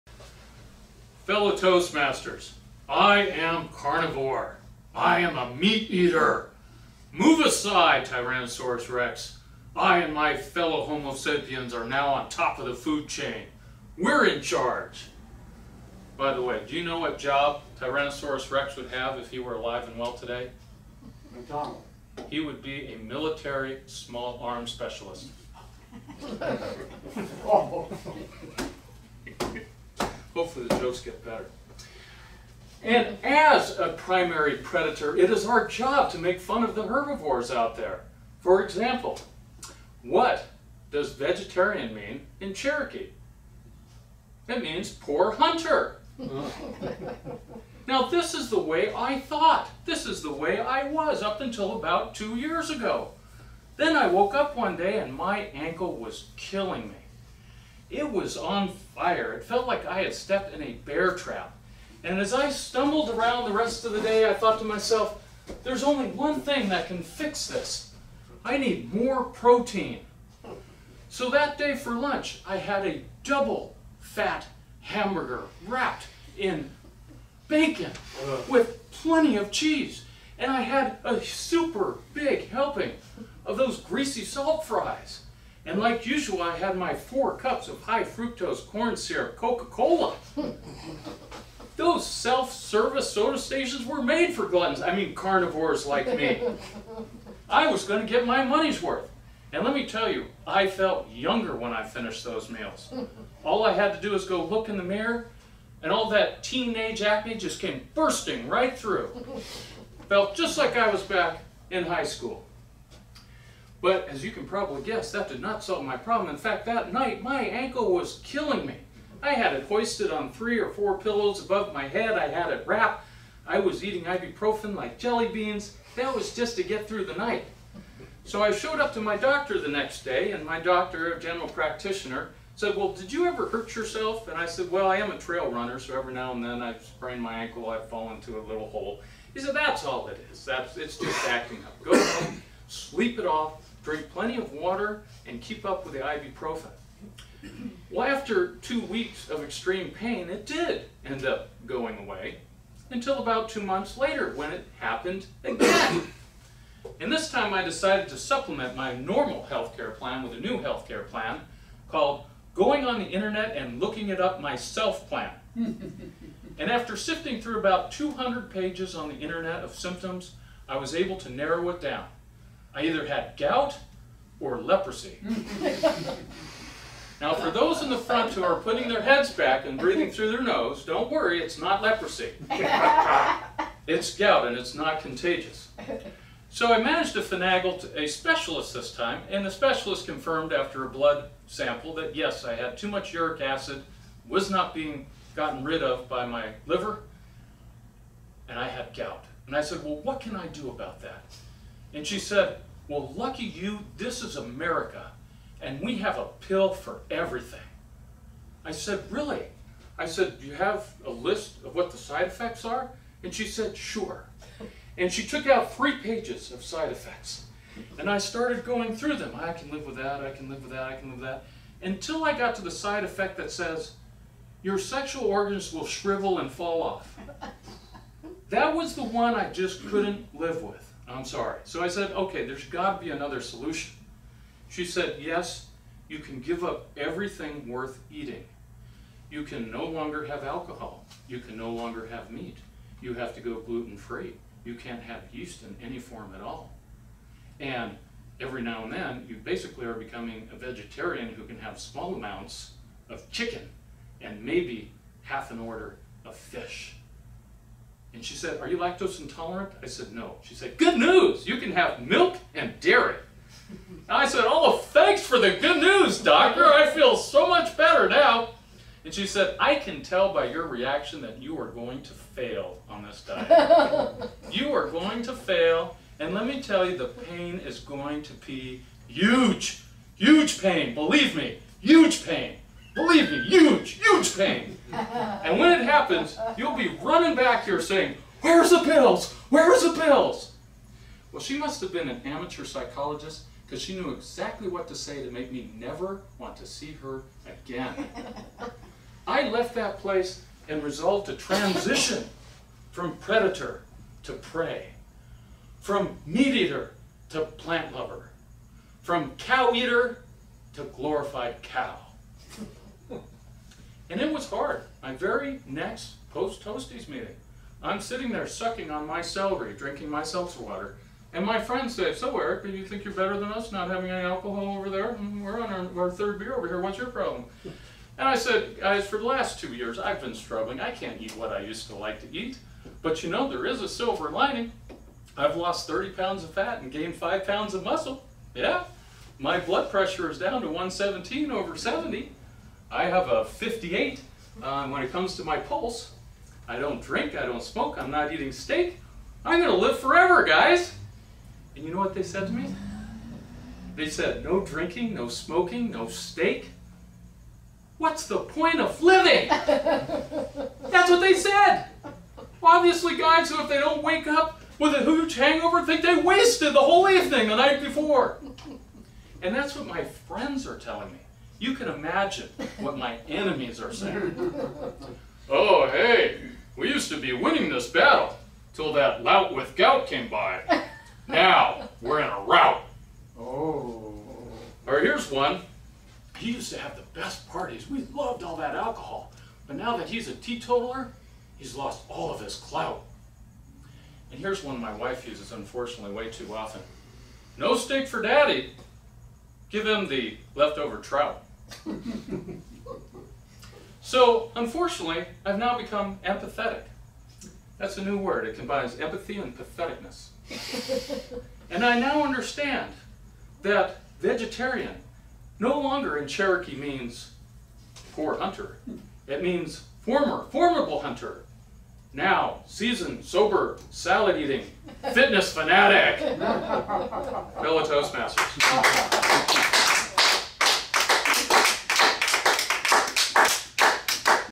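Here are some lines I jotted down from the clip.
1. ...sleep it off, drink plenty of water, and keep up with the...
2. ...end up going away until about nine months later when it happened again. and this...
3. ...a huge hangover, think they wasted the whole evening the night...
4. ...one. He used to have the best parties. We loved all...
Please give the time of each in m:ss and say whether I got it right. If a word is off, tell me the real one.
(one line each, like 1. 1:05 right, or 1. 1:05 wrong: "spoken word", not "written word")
1. 2:22 right
2. 2:31 wrong: "two", not "nine"
3. 6:04 right
4. 6:25 right.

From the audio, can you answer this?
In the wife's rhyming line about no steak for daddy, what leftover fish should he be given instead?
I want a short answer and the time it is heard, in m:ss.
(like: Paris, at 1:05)
Trout, at 6:40.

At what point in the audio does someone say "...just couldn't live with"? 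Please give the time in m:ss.
3:49.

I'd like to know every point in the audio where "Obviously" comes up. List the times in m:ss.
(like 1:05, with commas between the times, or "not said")
6:02.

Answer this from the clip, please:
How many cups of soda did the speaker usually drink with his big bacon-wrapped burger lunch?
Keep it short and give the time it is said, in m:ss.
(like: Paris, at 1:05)
4, at 1:26.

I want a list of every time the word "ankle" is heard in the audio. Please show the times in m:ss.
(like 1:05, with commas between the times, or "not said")
0:55, 1:57, 2:17.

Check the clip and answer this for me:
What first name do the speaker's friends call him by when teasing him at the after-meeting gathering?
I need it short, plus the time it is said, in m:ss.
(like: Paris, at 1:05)
Erik, at 5:22.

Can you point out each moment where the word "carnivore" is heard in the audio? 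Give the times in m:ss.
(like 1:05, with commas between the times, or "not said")
0:03, 1:35.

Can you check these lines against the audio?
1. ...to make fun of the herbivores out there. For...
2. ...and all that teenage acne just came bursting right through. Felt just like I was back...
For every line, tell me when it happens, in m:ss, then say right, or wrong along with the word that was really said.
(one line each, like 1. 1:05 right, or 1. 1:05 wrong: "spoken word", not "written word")
1. 0:36 right
2. 1:45 right.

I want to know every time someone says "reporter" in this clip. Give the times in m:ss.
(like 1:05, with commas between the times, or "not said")
not said.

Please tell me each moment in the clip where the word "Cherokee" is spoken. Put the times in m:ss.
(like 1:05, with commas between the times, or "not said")
0:42, 6:56.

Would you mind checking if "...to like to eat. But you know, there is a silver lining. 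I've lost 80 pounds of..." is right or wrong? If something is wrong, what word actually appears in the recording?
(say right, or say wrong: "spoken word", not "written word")
wrong: "30", not "80".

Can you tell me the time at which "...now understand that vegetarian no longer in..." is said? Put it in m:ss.
6:51.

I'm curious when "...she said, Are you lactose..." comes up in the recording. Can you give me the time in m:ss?
4:18.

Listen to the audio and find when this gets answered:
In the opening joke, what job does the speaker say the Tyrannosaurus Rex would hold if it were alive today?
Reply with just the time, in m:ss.
0:22.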